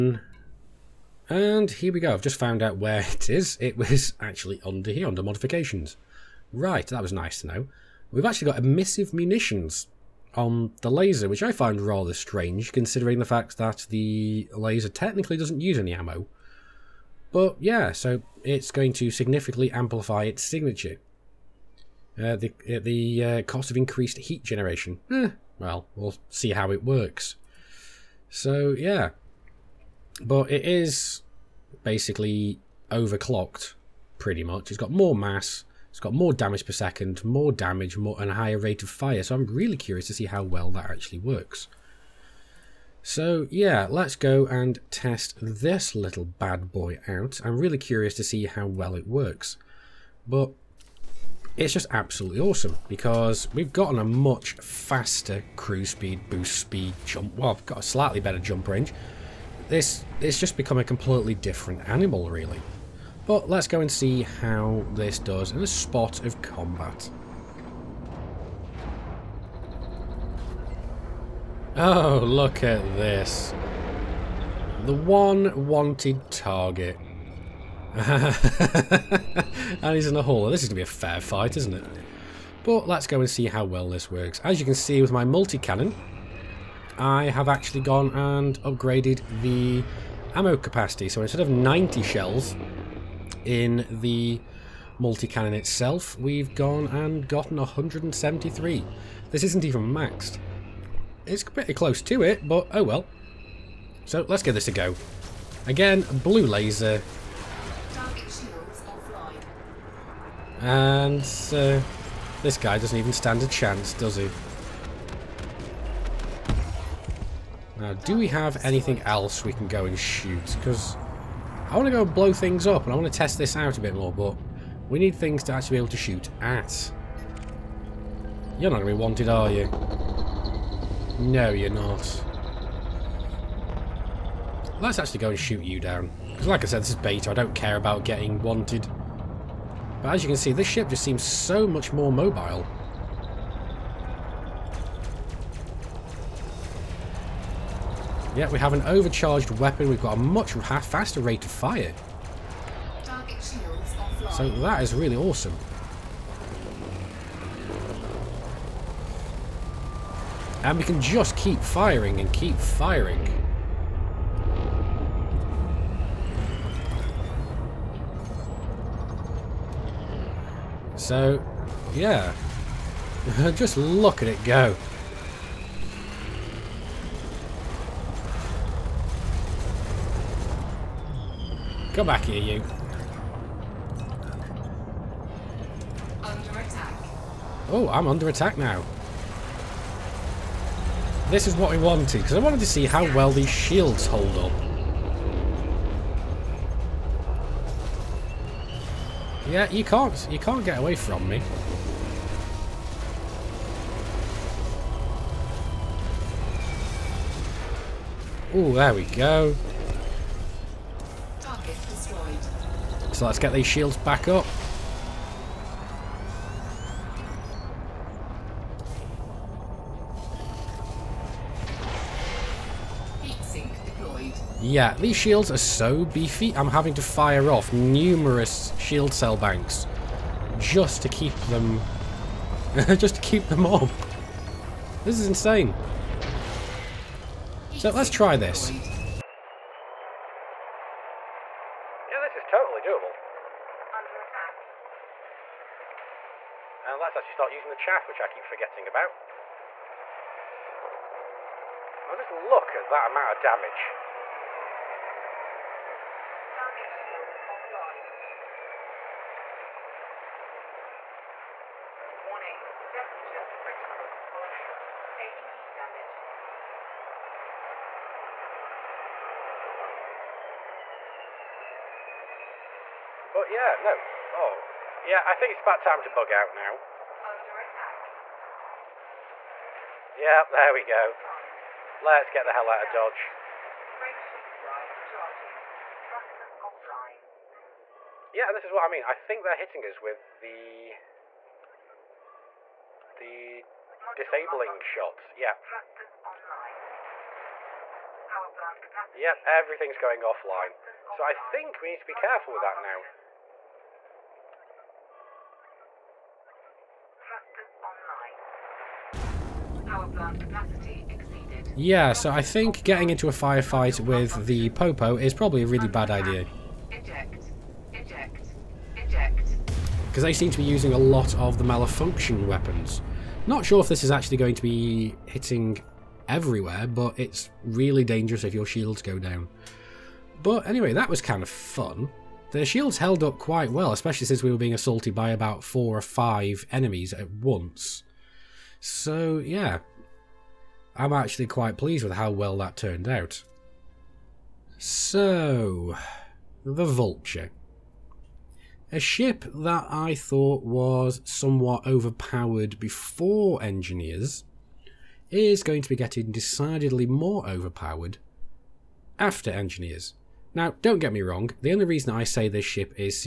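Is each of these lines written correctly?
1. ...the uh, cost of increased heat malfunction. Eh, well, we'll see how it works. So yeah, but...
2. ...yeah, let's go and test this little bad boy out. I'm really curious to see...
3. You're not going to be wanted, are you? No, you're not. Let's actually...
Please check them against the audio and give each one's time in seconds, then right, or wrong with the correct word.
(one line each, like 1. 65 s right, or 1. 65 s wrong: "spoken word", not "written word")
1. 22 s wrong: "generation", not "malfunction"
2. 43 s right
3. 128 s right.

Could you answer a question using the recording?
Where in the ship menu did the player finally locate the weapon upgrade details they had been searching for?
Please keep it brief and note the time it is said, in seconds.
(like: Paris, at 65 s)
modifications, at 5 s.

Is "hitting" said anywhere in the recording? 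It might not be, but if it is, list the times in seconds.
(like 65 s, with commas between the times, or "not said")
289 s, 325 s.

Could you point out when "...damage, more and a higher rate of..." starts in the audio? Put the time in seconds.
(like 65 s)
37 s.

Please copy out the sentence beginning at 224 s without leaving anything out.
Yeah, these shields are so beefy, I'm having to fire off numerous shield cell banks just to keep them...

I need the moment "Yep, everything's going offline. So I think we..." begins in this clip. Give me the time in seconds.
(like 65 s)
299 s.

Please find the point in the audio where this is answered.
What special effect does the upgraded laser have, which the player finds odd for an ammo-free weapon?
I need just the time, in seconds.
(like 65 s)
8 s.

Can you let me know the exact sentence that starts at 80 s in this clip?
This is going to be a fair fight, isn't it?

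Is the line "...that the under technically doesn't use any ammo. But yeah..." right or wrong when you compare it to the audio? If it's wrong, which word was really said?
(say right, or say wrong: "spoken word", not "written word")
wrong: "laser", not "under".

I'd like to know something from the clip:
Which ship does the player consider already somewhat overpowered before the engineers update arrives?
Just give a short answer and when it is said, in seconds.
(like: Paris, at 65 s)
Vulture, at 346 s.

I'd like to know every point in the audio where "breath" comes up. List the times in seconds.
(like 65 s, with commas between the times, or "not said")
not said.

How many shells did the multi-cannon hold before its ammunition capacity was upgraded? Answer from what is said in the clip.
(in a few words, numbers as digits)
90.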